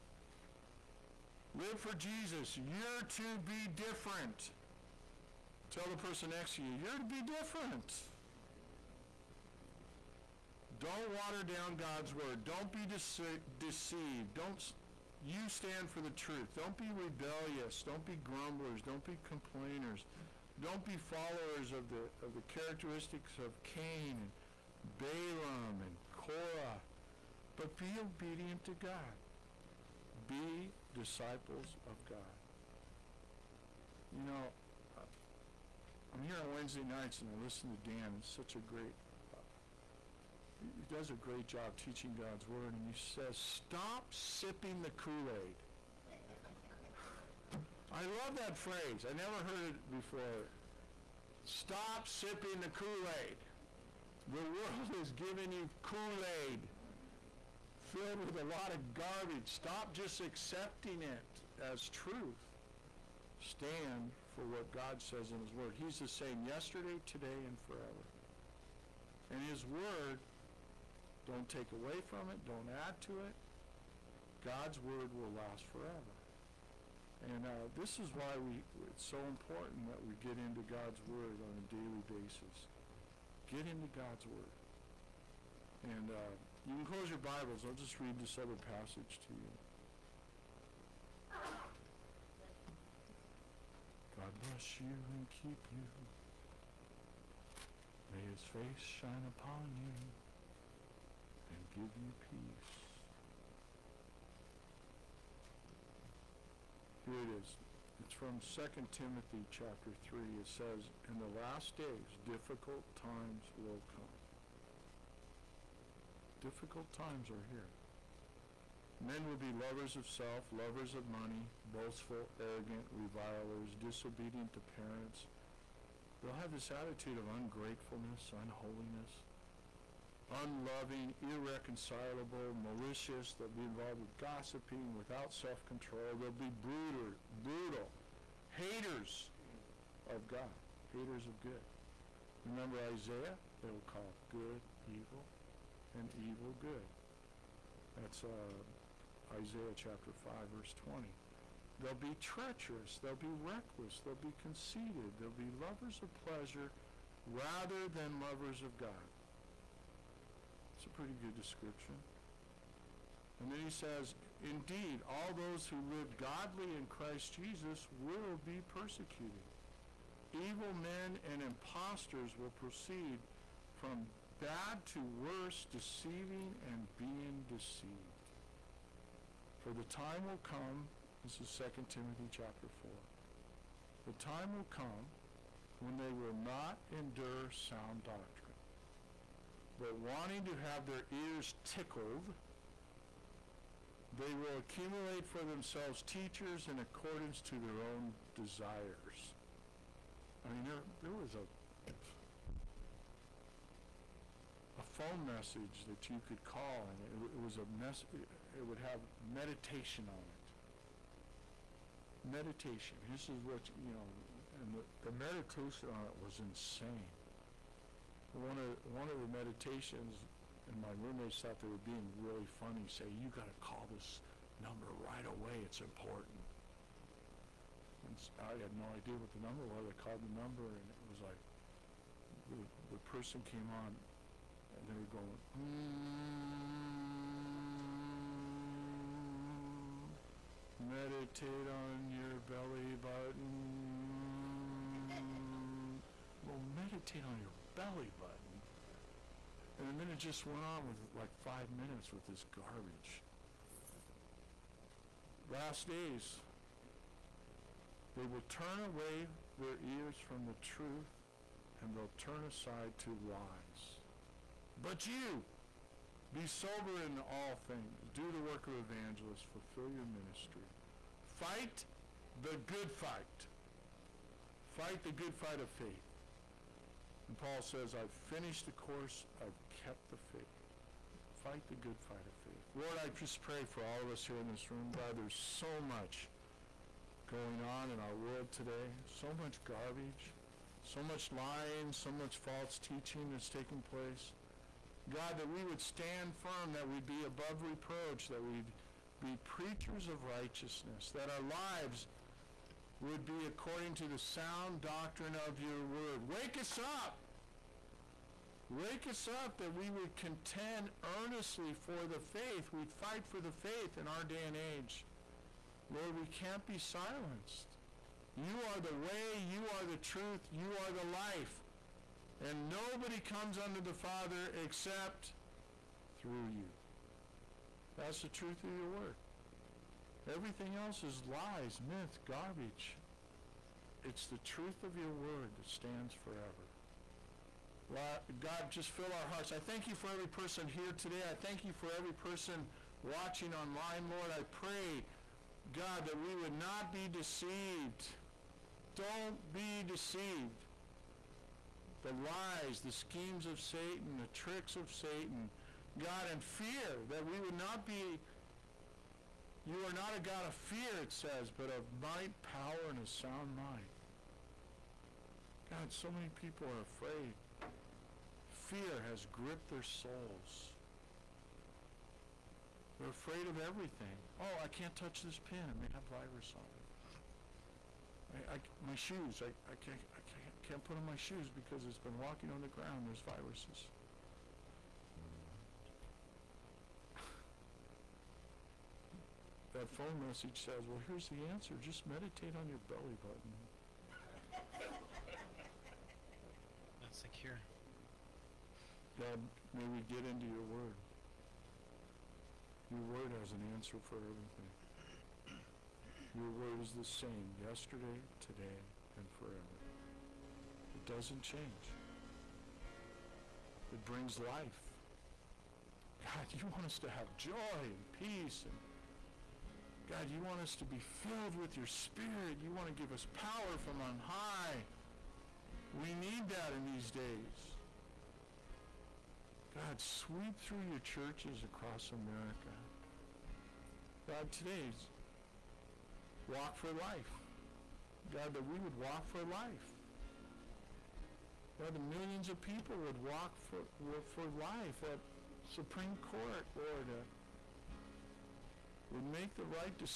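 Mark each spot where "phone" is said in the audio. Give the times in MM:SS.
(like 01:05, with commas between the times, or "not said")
03:24, 06:29.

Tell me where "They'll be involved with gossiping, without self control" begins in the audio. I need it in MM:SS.
02:13.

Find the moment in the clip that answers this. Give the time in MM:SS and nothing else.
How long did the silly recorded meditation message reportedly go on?
04:11.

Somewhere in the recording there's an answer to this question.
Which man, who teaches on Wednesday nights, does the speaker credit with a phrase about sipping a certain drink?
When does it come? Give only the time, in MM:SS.
00:37.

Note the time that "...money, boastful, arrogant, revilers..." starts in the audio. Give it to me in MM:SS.
02:01.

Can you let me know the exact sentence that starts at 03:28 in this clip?
It would have meditation on it.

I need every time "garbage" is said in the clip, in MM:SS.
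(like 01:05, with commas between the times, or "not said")
00:58, 04:12, 04:49, 05:32.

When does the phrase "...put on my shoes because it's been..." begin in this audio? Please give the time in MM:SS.
06:20.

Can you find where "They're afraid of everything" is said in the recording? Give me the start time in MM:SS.
06:12.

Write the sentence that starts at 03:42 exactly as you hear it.
Say, you got to call this number right away.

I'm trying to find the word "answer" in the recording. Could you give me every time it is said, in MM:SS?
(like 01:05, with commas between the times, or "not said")
06:31, 06:43.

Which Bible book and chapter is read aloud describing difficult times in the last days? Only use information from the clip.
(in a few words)
2 Timothy chapter 3.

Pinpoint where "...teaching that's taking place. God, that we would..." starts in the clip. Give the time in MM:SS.
04:52.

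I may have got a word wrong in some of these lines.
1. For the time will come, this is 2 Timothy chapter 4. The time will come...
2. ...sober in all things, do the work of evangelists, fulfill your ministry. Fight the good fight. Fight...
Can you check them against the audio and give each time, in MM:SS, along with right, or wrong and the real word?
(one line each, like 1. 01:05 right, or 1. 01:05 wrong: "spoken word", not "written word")
1. 02:59 right
2. 04:26 right.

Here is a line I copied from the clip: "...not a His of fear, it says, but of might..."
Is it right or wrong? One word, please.
wrong.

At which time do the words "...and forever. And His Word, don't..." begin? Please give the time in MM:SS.
01:07.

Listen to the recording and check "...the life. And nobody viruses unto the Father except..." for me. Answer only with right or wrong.
wrong.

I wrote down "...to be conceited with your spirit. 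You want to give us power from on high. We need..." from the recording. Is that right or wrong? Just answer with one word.
wrong.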